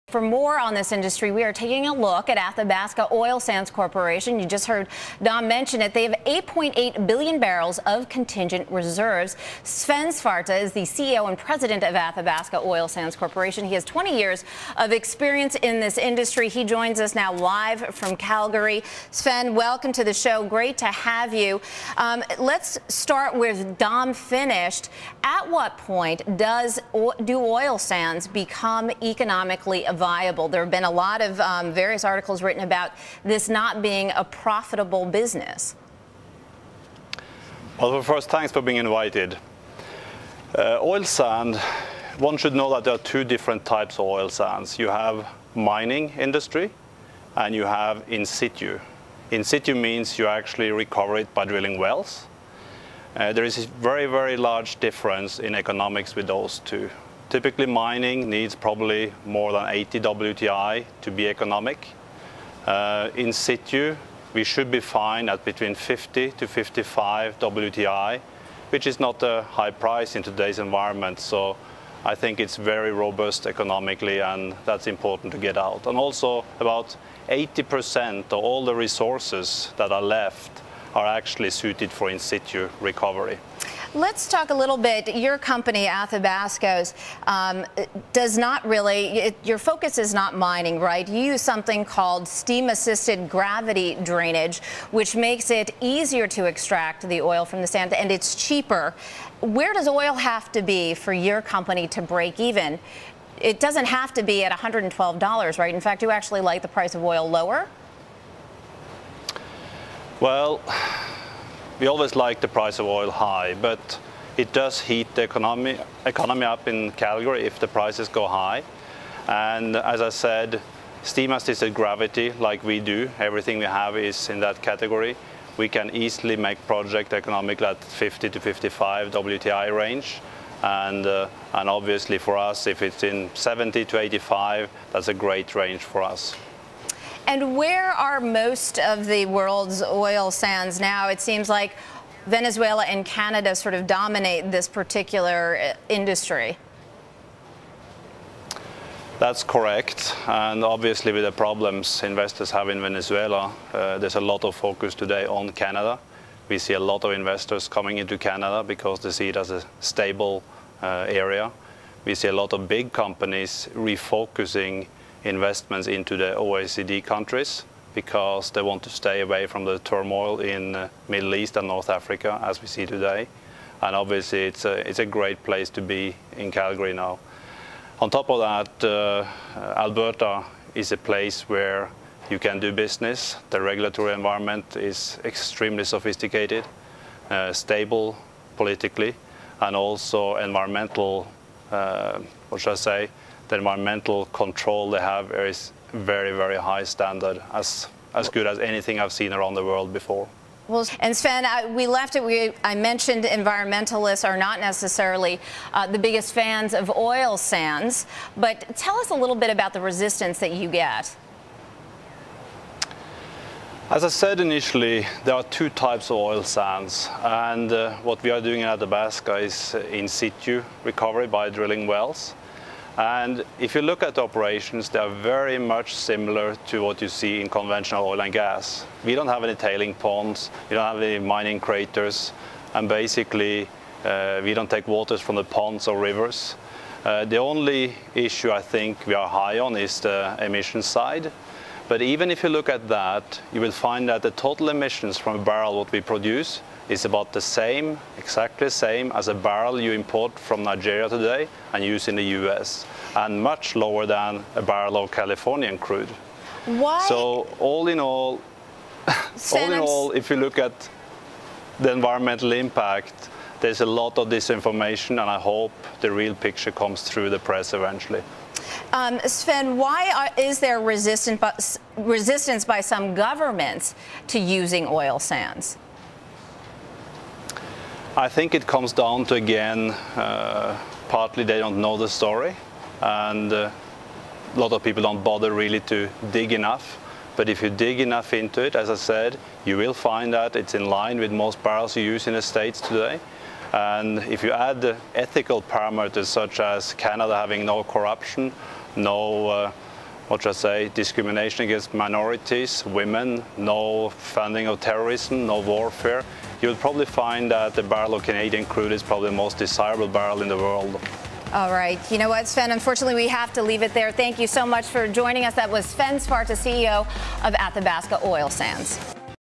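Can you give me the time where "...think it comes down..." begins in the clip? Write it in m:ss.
4:38.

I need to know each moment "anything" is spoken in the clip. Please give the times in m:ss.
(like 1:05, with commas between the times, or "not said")
3:18.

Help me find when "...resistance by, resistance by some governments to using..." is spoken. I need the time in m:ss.
4:30.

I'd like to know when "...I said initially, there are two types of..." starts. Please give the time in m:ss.
3:34.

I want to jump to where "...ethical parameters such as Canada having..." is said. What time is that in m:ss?
4:55.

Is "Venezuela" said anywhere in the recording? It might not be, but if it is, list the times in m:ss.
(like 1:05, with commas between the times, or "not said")
2:22, 2:32.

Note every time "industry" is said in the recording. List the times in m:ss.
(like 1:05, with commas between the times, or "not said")
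0:00, 0:15, 0:46, 2:25.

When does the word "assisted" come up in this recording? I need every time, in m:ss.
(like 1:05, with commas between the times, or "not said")
1:32, 2:01.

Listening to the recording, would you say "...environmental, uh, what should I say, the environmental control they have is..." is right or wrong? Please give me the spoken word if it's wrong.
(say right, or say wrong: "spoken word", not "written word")
right.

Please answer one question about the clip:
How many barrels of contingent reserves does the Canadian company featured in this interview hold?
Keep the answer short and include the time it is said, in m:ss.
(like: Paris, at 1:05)
8.8 billion barrels, at 0:06.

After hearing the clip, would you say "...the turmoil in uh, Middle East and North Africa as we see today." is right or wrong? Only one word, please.
right.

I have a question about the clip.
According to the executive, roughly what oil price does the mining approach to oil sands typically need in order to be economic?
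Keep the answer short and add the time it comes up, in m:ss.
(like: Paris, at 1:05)
more than 80 WTI, at 0:59.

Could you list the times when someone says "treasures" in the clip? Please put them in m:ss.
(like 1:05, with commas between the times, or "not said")
not said.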